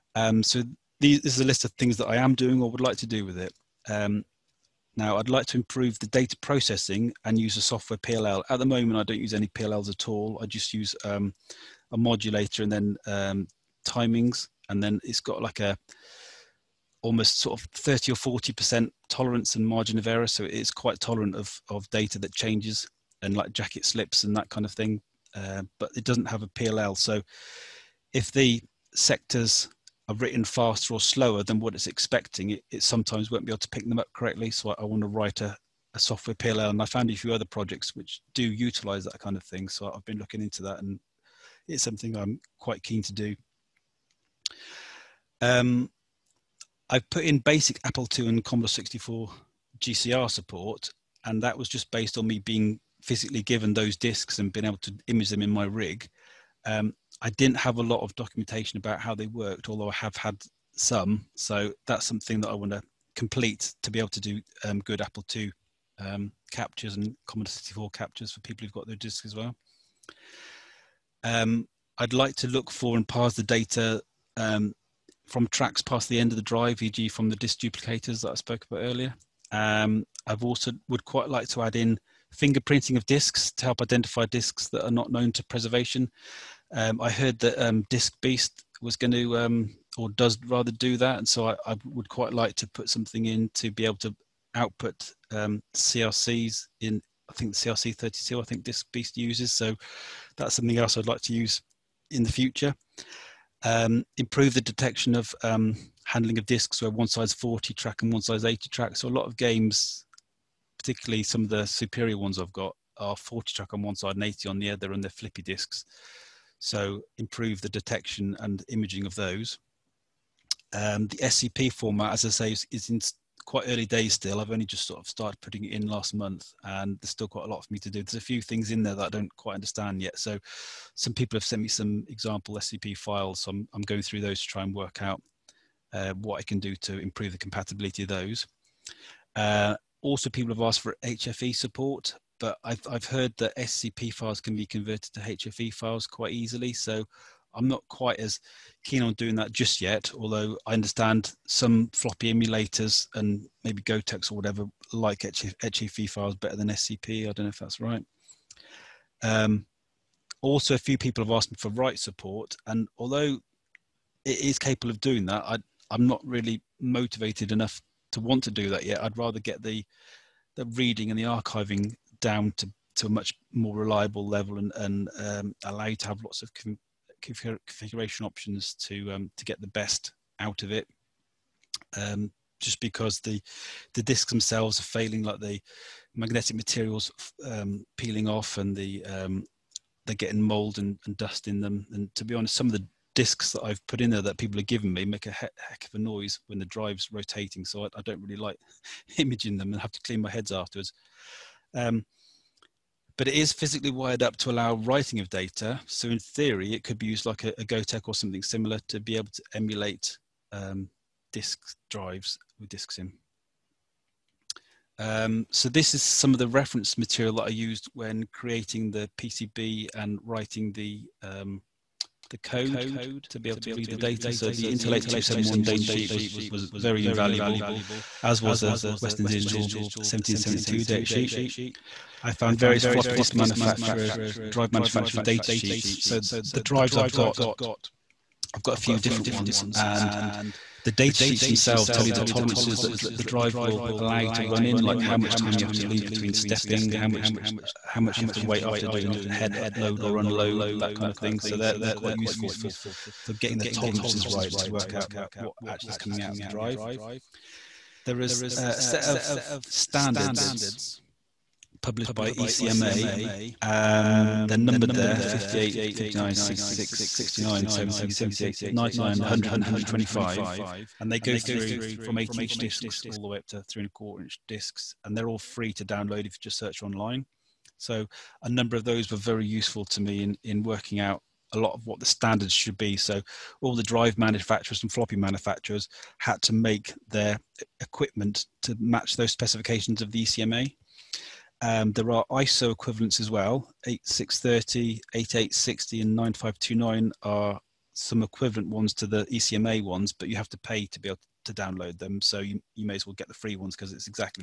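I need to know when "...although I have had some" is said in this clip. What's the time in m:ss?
0:59.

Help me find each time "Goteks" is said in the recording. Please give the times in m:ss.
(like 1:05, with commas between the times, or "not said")
2:33, 3:27.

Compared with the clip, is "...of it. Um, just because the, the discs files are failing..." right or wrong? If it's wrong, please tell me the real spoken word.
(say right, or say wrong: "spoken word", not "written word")
wrong: "themselves", not "files".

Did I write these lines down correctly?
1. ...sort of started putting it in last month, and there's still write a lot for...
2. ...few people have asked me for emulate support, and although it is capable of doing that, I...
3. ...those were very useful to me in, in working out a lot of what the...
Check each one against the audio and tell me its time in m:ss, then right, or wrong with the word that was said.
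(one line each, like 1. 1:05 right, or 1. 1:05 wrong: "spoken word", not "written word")
1. 2:04 wrong: "quite", not "write"
2. 2:40 wrong: "write", not "emulate"
3. 4:38 right.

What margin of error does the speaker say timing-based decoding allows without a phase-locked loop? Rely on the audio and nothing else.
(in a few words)
30 or 40 percent.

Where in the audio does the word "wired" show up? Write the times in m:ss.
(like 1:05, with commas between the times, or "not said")
3:23.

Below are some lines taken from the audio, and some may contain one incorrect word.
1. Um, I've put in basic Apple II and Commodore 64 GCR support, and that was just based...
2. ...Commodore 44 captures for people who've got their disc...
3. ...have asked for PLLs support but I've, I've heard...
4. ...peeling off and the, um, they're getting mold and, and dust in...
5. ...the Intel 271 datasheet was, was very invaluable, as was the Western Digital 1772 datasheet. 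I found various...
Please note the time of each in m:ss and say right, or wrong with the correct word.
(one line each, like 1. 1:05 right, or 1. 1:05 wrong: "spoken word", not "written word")
1. 0:45 right
2. 1:07 wrong: "64", not "44"
3. 2:20 wrong: "HFE", not "PLLs"
4. 3:07 right
5. 3:44 right.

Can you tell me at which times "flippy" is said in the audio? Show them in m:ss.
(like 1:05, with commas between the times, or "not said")
1:55.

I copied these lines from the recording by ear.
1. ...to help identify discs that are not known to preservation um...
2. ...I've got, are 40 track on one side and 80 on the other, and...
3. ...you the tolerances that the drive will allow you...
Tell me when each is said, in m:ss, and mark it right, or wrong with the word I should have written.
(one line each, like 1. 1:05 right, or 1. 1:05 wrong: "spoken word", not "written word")
1. 1:23 right
2. 1:52 right
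3. 4:02 right.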